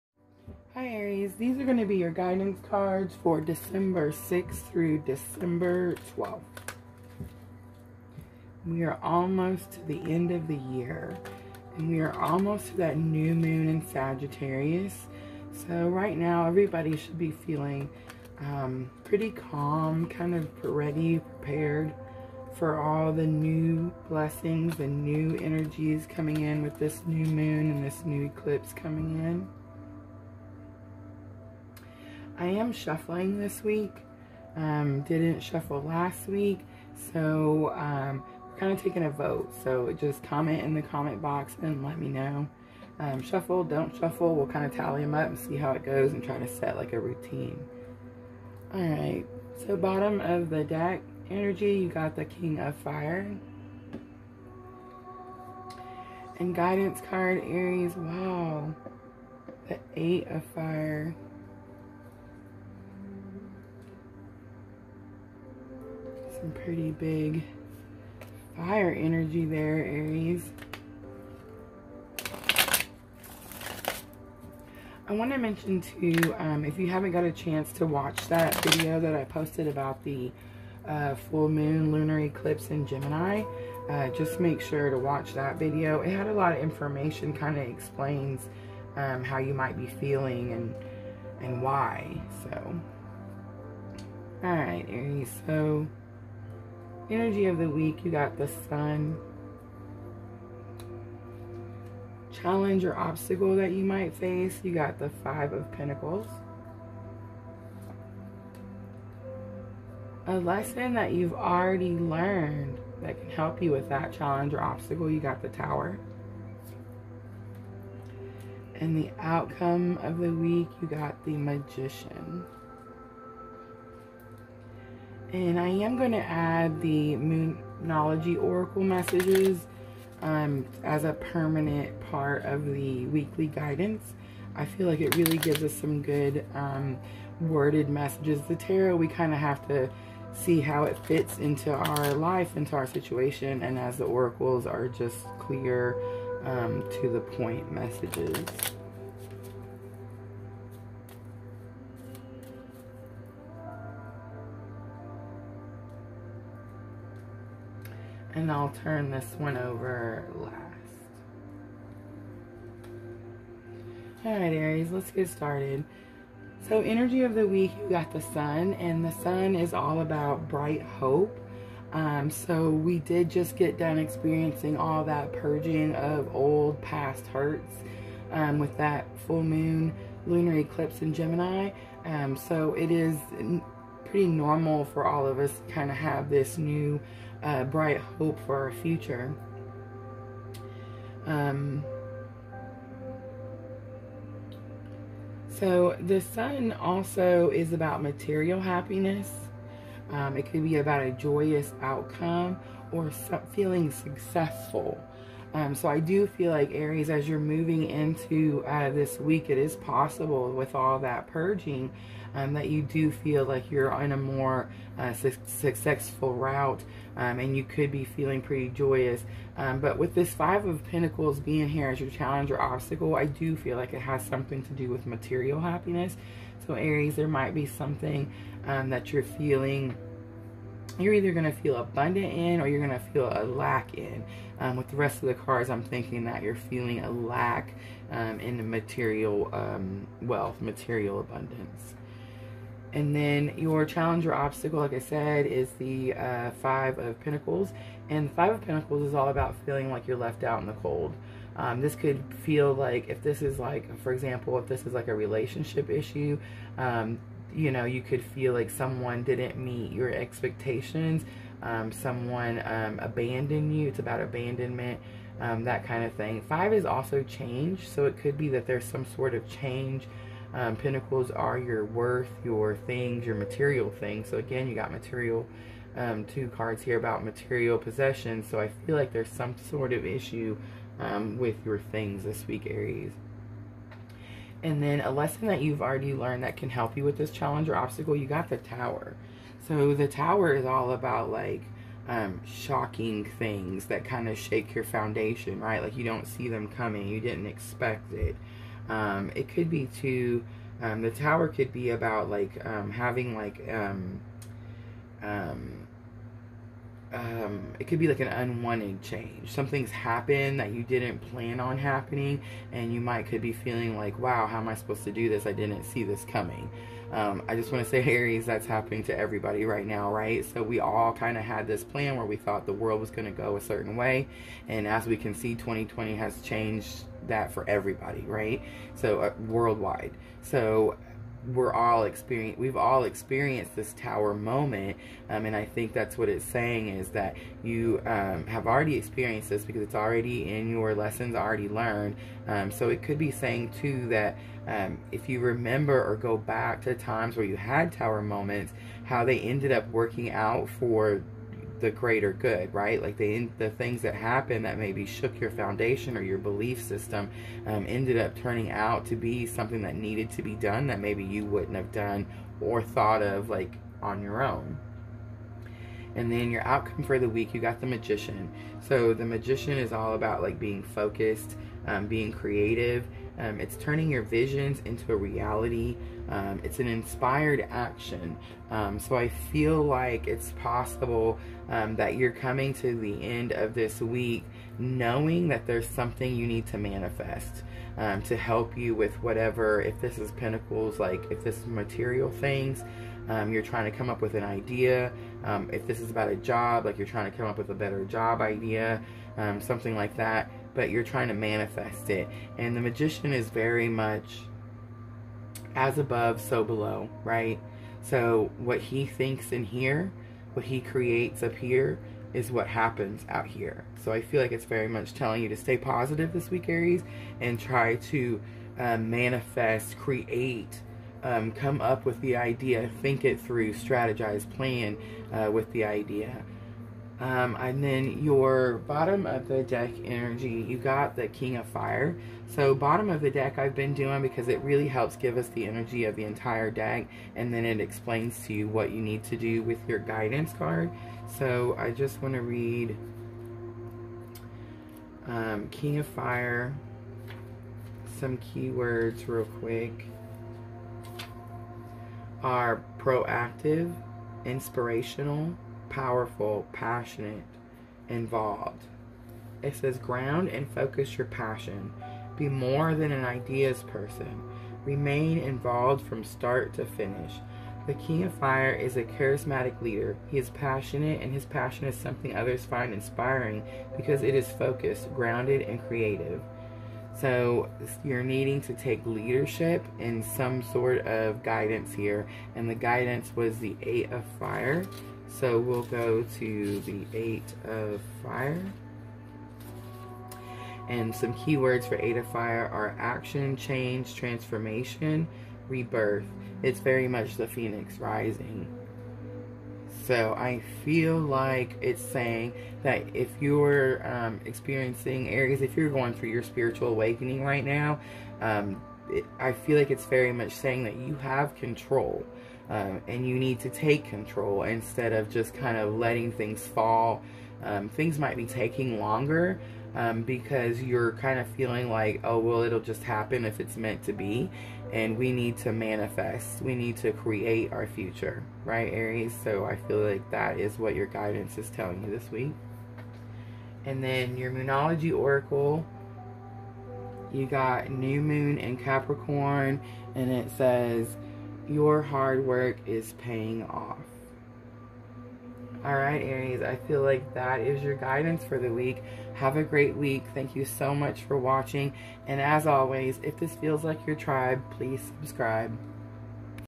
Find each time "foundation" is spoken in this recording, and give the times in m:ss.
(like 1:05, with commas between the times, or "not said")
4:54, 5:55.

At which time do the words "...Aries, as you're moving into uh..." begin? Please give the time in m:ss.
3:26.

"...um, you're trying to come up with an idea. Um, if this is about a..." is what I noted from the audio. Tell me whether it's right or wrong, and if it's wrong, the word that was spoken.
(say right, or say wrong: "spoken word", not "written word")
right.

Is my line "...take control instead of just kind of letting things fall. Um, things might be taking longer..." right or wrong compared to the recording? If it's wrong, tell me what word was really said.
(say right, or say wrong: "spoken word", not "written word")
right.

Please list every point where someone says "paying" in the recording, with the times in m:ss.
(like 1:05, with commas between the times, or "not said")
9:03.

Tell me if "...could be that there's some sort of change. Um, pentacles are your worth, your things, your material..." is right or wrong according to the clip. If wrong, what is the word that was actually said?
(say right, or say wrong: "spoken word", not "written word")
right.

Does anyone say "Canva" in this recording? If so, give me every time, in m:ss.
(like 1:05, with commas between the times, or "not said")
not said.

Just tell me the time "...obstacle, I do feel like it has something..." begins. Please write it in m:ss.
3:42.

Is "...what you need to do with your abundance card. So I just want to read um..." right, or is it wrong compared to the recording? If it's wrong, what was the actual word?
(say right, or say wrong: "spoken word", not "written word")
wrong: "guidance", not "abundance".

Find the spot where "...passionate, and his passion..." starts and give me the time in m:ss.
7:50.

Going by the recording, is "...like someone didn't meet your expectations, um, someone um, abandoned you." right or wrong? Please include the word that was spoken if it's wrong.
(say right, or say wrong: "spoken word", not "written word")
right.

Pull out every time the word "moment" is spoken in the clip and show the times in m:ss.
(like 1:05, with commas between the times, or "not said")
5:34, 5:48.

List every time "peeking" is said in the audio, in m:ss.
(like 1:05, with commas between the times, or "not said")
not said.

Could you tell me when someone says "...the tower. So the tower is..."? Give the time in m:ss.
4:48.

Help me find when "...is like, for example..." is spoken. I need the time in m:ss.
4:13.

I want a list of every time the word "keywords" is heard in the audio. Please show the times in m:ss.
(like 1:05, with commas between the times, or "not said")
7:28, 8:11.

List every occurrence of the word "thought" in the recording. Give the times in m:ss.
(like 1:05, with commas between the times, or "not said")
5:22, 6:02.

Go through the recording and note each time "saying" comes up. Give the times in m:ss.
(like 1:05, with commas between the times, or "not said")
5:36, 5:43, 8:22, 8:30.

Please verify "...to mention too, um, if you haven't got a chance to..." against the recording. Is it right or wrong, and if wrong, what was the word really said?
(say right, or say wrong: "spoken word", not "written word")
right.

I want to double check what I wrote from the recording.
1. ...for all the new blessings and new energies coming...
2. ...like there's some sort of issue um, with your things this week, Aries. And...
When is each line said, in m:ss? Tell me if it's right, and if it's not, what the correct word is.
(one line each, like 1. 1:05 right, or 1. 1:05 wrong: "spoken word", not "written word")
1. 0:22 right
2. 4:38 right.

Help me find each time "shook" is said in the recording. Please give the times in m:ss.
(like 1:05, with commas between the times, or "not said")
5:55.